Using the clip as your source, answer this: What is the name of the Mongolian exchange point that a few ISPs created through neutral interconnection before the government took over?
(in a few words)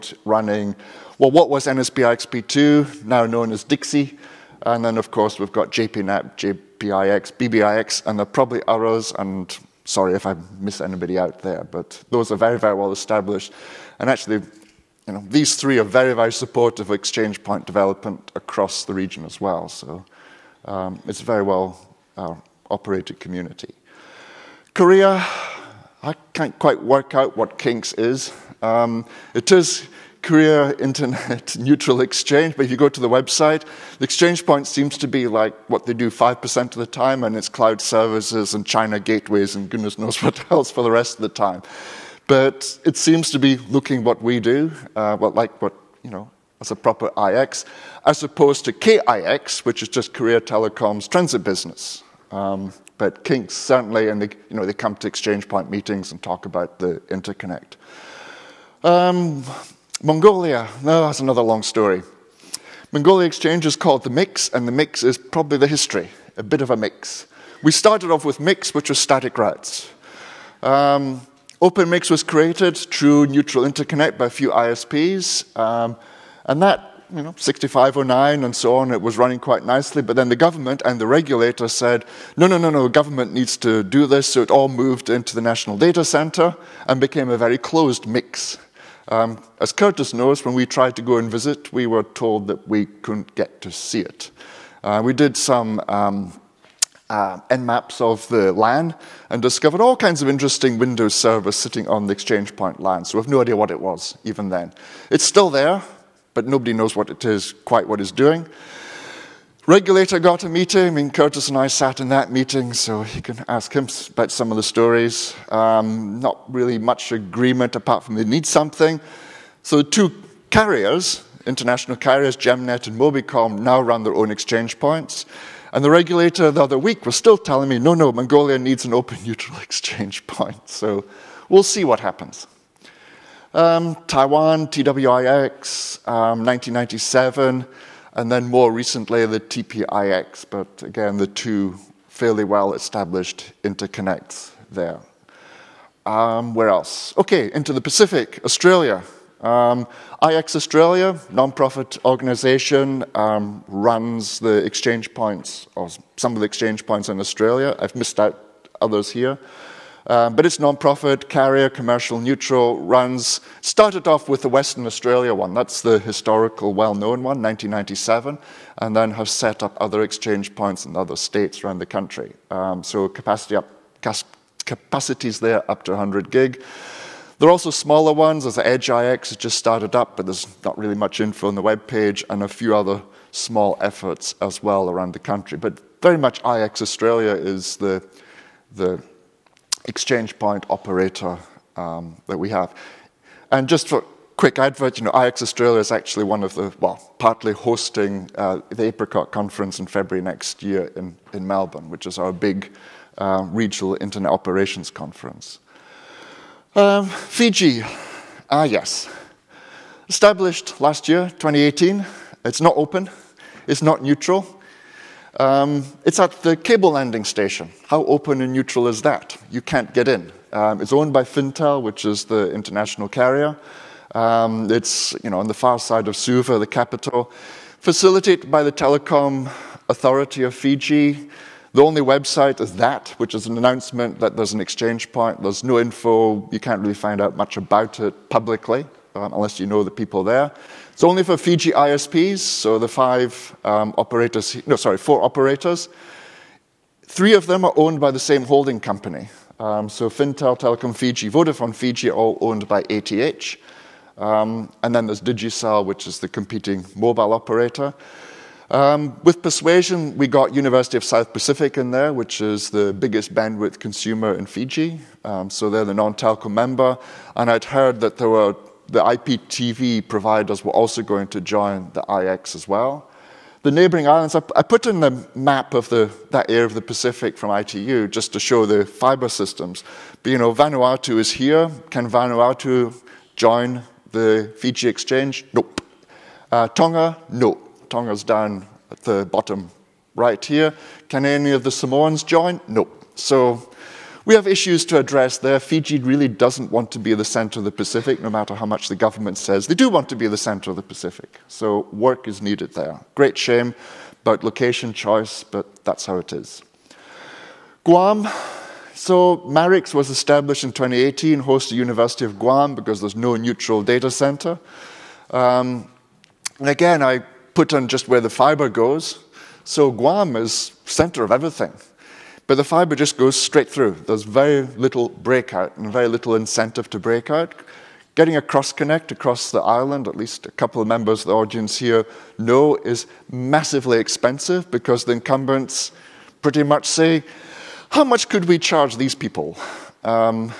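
OpenMix.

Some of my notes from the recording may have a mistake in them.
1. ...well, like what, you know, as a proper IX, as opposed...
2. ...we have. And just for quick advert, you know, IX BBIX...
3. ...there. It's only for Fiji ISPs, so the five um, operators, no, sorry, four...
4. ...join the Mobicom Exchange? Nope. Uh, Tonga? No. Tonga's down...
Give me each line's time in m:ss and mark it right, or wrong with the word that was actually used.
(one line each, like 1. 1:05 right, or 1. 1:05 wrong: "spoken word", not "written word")
1. 0:45 right
2. 3:12 wrong: "Australia", not "BBIX"
3. 4:00 right
4. 4:43 wrong: "Fiji", not "Mobicom".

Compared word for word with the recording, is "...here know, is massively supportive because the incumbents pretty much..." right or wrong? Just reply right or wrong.
wrong.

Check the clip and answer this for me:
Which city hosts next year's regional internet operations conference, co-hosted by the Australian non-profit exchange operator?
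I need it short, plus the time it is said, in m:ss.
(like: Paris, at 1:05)
Melbourne, at 3:21.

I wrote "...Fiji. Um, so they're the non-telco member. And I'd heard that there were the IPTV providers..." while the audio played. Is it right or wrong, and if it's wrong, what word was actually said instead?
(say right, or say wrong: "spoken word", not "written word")
right.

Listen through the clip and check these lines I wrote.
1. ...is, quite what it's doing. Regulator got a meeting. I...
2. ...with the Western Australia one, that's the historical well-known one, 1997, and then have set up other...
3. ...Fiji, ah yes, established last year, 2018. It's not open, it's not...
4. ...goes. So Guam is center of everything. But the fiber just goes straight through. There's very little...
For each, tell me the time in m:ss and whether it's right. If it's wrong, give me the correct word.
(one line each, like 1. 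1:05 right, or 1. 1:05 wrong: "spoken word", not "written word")
1. 1:47 right
2. 2:44 right
3. 3:27 right
4. 5:18 right.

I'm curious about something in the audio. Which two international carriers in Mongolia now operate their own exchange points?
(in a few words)
Gemnet and Mobicom.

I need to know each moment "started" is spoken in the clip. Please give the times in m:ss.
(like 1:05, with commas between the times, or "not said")
1:07, 2:43, 2:59.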